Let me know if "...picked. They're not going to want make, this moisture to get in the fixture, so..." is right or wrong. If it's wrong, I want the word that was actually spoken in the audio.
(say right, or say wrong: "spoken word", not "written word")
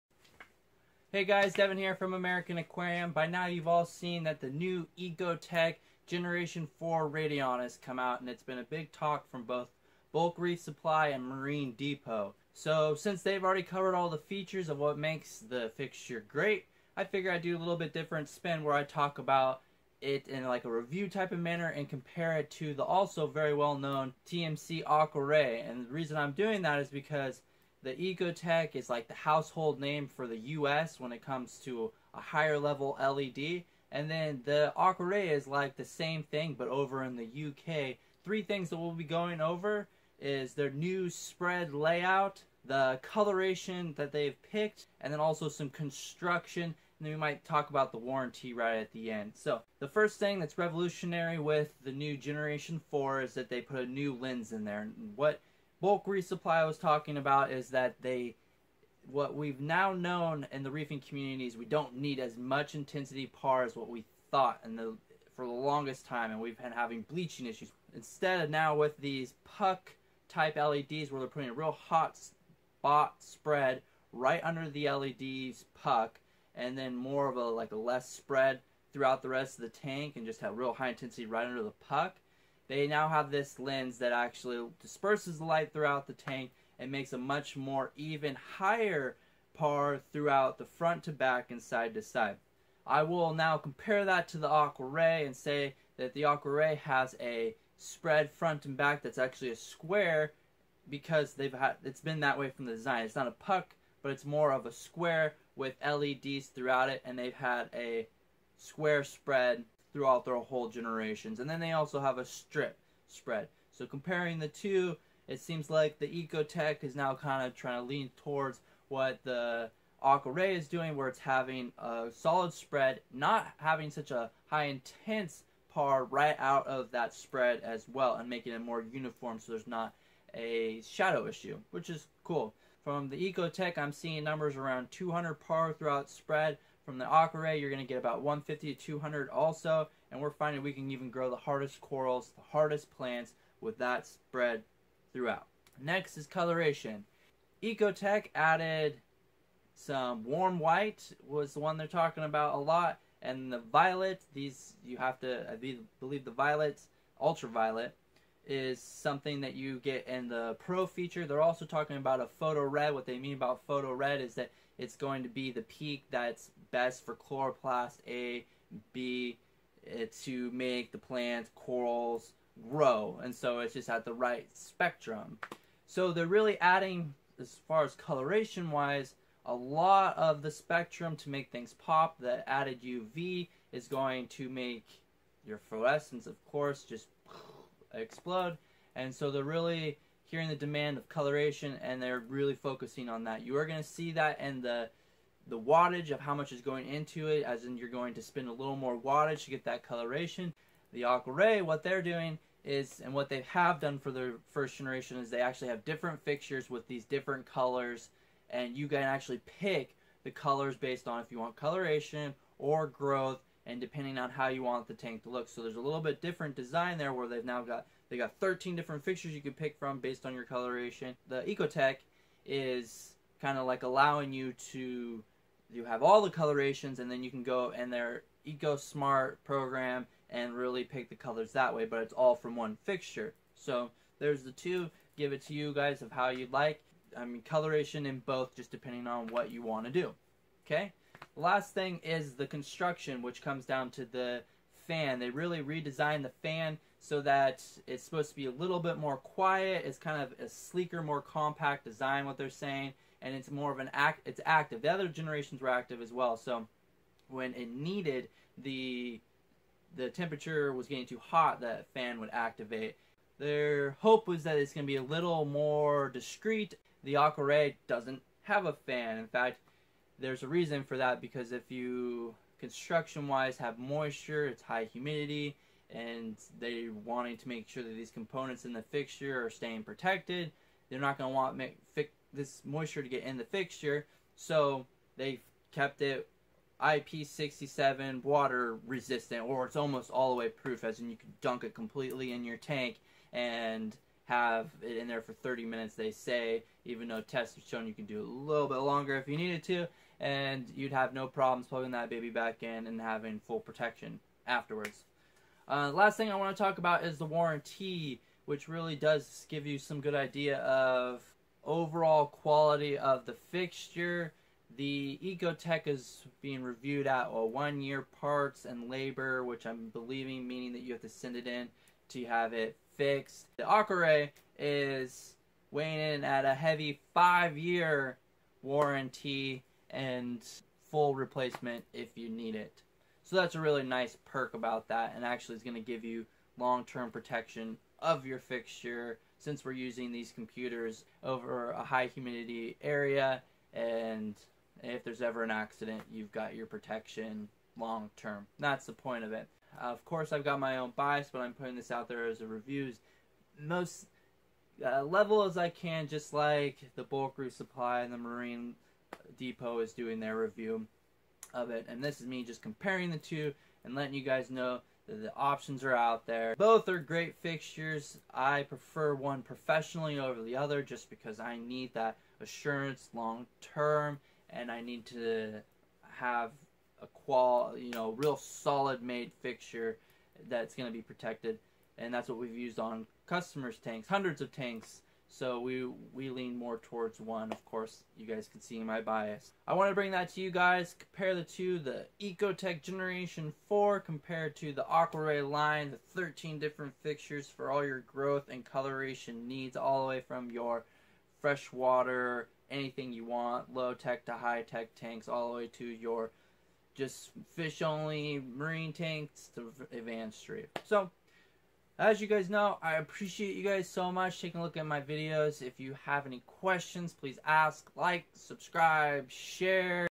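wrong: "protected", not "picked".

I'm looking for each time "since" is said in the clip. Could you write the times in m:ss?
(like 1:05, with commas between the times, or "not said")
0:12, 5:39.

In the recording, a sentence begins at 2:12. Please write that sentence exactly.
From the Ecotech, I'm seeing numbers around 200 par throughout spread.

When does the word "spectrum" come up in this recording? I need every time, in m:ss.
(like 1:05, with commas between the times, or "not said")
2:54, 3:00.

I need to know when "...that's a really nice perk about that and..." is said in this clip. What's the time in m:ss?
5:33.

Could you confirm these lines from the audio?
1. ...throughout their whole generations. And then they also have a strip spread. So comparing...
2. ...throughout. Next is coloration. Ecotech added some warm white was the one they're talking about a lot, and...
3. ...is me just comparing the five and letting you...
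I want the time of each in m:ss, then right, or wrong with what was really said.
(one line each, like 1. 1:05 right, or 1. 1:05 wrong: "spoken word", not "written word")
1. 1:49 right
2. 2:25 right
3. 6:02 wrong: "two", not "five".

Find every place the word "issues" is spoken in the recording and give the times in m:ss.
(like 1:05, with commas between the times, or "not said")
1:07, 2:11.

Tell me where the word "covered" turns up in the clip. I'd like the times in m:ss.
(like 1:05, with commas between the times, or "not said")
0:13.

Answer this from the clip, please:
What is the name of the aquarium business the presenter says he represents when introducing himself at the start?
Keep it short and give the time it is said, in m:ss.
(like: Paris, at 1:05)
American Aquarium, at 0:02.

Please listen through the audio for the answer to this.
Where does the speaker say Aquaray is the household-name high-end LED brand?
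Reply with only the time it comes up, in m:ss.
0:37.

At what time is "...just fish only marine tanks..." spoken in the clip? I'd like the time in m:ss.
6:46.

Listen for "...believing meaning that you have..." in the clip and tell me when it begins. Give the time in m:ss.
5:19.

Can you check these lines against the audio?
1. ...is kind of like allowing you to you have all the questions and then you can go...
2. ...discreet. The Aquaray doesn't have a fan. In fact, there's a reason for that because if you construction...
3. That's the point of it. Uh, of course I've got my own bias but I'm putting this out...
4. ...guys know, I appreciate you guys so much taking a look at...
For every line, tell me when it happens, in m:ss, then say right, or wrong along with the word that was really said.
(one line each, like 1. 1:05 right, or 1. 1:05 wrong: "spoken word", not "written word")
1. 3:42 wrong: "colorations", not "questions"
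2. 4:26 right
3. 5:48 right
4. 6:52 right.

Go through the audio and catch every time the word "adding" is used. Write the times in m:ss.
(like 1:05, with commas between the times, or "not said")
2:56.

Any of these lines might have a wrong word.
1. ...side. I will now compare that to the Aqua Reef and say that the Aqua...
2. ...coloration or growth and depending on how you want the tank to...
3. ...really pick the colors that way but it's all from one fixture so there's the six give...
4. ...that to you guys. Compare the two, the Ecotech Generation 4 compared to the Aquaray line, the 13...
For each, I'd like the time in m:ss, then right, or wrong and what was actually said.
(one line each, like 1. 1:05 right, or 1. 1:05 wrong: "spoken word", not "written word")
1. 1:32 wrong: "Ray", not "Reef"
2. 3:31 right
3. 3:50 wrong: "two", not "six"
4. 6:30 right.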